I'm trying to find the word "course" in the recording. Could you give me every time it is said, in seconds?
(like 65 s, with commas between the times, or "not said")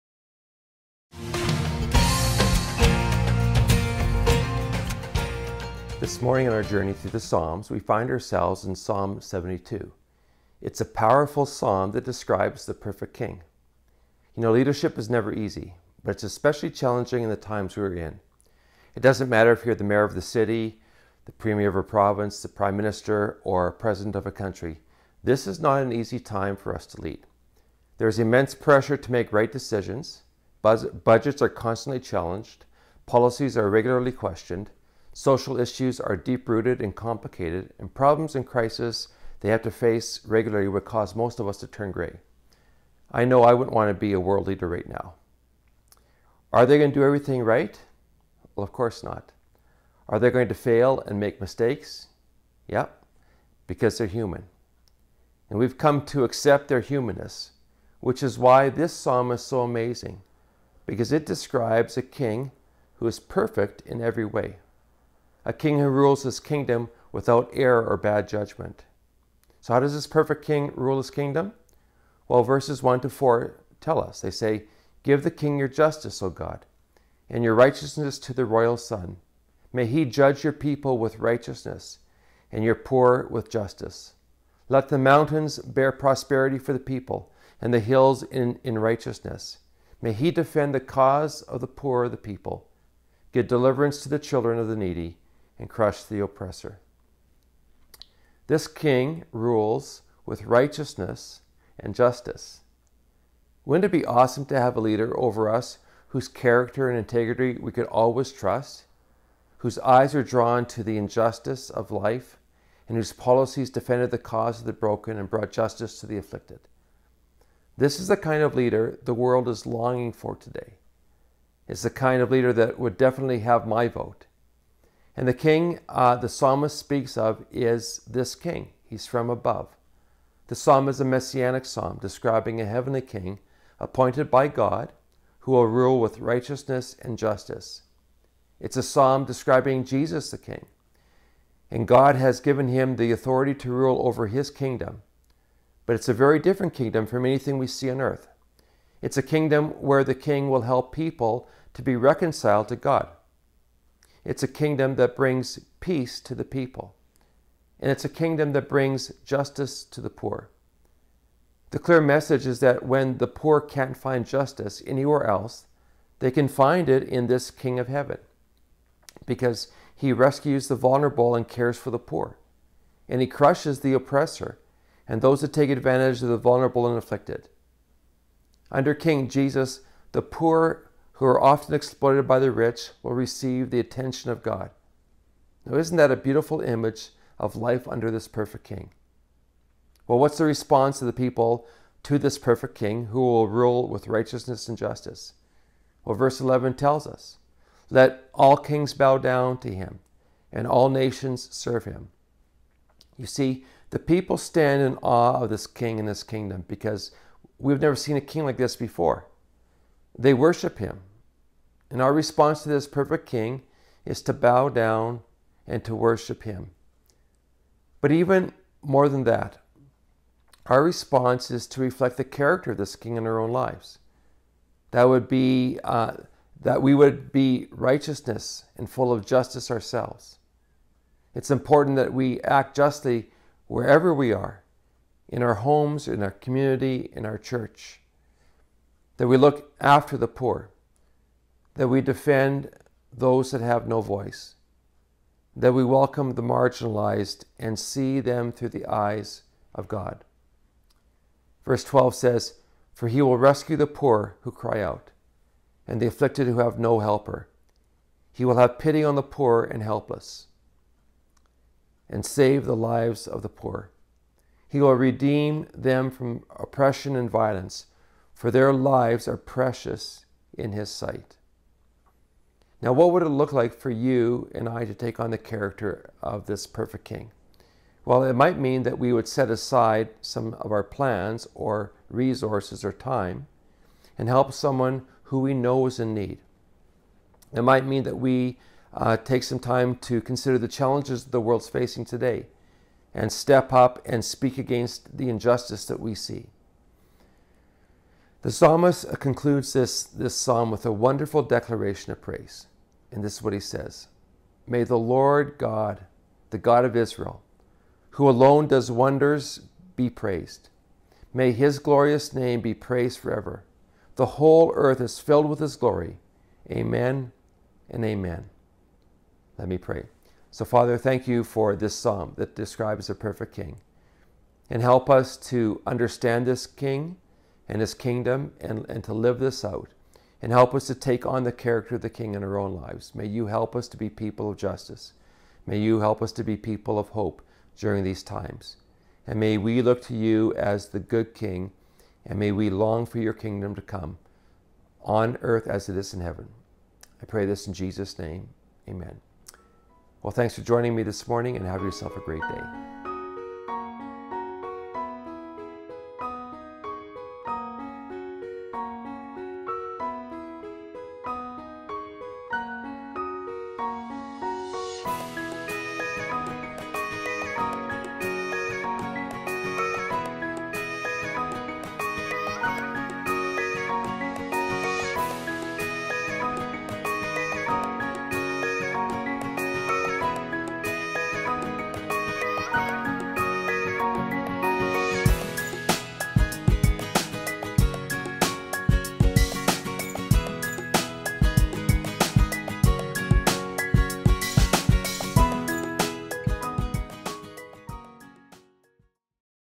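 48 s.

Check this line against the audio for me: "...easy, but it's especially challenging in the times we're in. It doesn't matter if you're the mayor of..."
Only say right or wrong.
right.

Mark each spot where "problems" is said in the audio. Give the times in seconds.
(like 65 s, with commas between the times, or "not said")
37 s.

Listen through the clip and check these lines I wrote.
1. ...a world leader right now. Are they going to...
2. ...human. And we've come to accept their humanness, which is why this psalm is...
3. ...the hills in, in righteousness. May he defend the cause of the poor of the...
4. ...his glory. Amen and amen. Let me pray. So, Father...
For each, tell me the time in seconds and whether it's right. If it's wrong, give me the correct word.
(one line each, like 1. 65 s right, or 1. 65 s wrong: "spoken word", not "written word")
1. 44 s right
2. 54 s right
3. 87 s right
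4. 315 s right.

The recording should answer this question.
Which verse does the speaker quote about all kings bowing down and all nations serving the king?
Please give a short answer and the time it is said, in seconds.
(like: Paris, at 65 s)
Verse 11, at 196 s.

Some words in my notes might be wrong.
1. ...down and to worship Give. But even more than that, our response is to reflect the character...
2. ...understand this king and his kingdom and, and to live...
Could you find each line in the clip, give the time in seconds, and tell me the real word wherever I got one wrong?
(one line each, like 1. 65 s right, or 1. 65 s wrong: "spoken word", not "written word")
1. 214 s wrong: "Him", not "Give"
2. 325 s right.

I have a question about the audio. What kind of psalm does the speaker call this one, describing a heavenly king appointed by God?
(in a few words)
Messianic psalm.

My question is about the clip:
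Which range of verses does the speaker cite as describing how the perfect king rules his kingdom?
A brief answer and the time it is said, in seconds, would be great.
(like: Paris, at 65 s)
1 to 4, at 72 s.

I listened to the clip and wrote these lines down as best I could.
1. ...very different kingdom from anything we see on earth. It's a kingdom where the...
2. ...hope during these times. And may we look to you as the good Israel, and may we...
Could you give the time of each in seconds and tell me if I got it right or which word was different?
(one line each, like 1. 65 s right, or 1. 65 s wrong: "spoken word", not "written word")
1. 146 s right
2. 337 s wrong: "King", not "Israel".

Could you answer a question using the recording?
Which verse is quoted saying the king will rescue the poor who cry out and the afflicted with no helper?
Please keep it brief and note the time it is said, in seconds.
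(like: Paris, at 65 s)
Verse 12, at 251 s.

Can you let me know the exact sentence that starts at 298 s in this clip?
The psalmist concludes this, this psalm with a wonderful declaration of praise.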